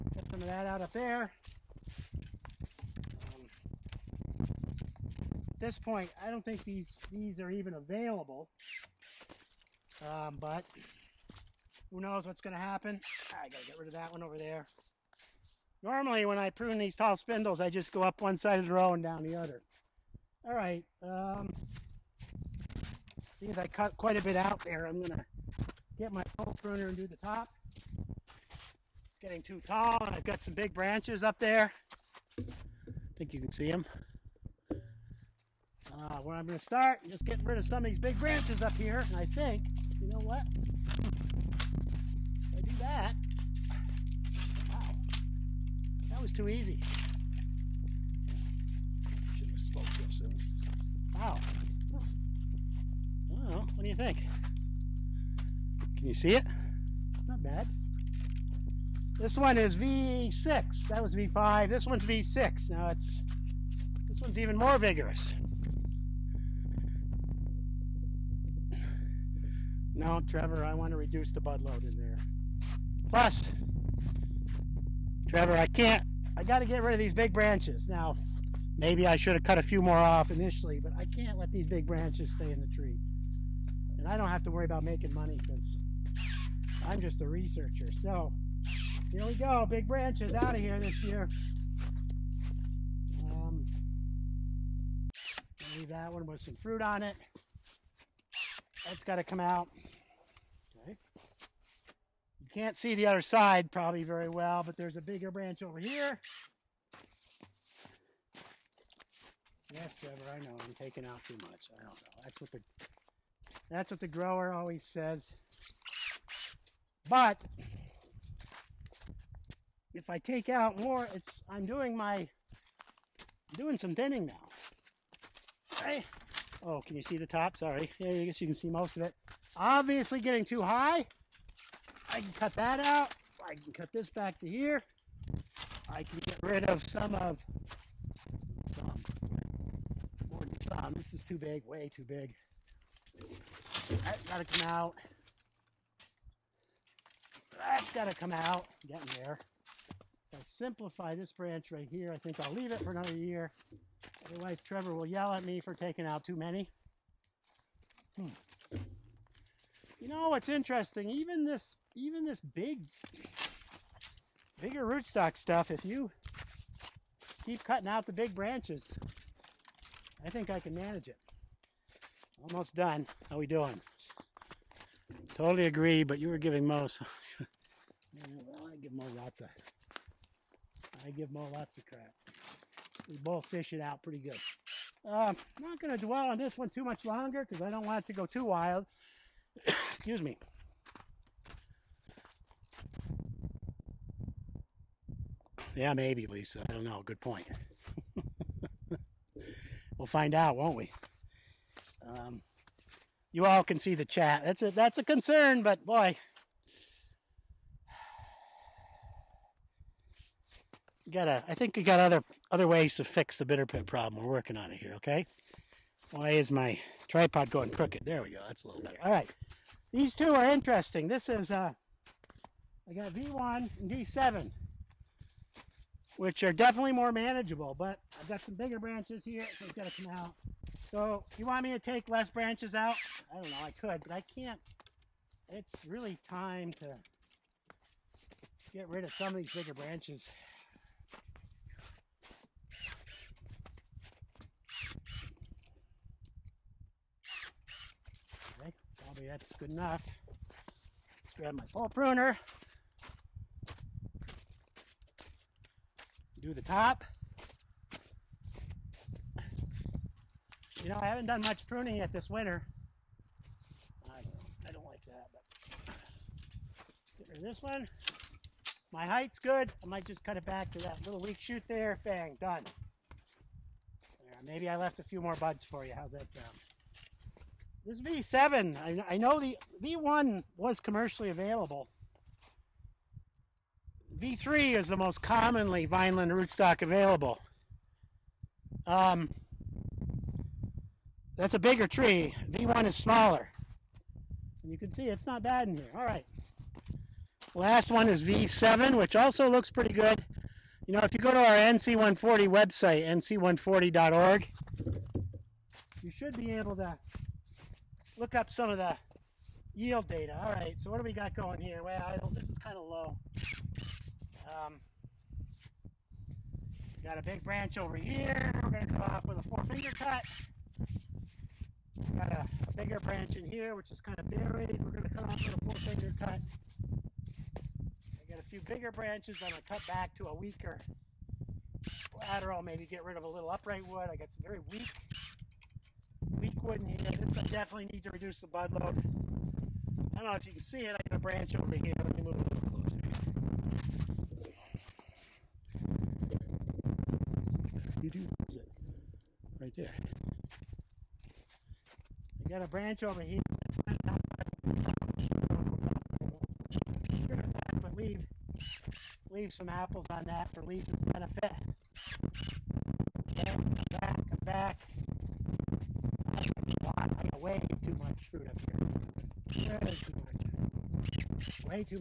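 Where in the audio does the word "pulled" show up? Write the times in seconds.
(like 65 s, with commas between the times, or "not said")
not said.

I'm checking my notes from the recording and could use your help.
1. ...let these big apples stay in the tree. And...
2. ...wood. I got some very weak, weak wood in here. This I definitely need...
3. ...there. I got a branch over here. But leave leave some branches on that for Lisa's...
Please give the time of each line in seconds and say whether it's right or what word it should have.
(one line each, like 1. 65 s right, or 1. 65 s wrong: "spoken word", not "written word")
1. 81 s wrong: "branches", not "apples"
2. 333 s right
3. 349 s wrong: "apples", not "branches".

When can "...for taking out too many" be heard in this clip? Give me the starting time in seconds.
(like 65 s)
155 s.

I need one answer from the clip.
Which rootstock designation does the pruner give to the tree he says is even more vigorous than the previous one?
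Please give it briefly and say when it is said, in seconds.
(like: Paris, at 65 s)
V6, at 61 s.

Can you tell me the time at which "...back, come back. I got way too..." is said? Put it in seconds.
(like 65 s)
363 s.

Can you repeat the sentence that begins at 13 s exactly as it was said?
I gotta get rid of that one over there.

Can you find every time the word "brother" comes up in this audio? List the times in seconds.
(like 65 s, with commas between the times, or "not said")
not said.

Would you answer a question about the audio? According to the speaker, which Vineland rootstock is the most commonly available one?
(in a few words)
V3.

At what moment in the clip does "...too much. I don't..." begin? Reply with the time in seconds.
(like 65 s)
111 s.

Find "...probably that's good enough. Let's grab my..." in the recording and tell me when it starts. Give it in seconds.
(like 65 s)
249 s.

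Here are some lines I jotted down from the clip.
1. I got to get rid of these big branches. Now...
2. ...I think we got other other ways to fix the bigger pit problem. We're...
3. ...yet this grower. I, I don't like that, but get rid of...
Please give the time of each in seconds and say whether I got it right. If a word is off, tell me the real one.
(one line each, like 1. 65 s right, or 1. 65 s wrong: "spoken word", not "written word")
1. 76 s right
2. 211 s wrong: "bitter", not "bigger"
3. 261 s wrong: "winter", not "grower".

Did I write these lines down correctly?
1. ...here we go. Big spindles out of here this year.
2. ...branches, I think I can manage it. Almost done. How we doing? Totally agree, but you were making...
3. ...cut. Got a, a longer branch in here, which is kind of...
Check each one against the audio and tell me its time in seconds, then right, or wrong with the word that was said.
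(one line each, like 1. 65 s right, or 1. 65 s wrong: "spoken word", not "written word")
1. 89 s wrong: "branches", not "spindles"
2. 168 s wrong: "giving", not "making"
3. 319 s wrong: "bigger", not "longer".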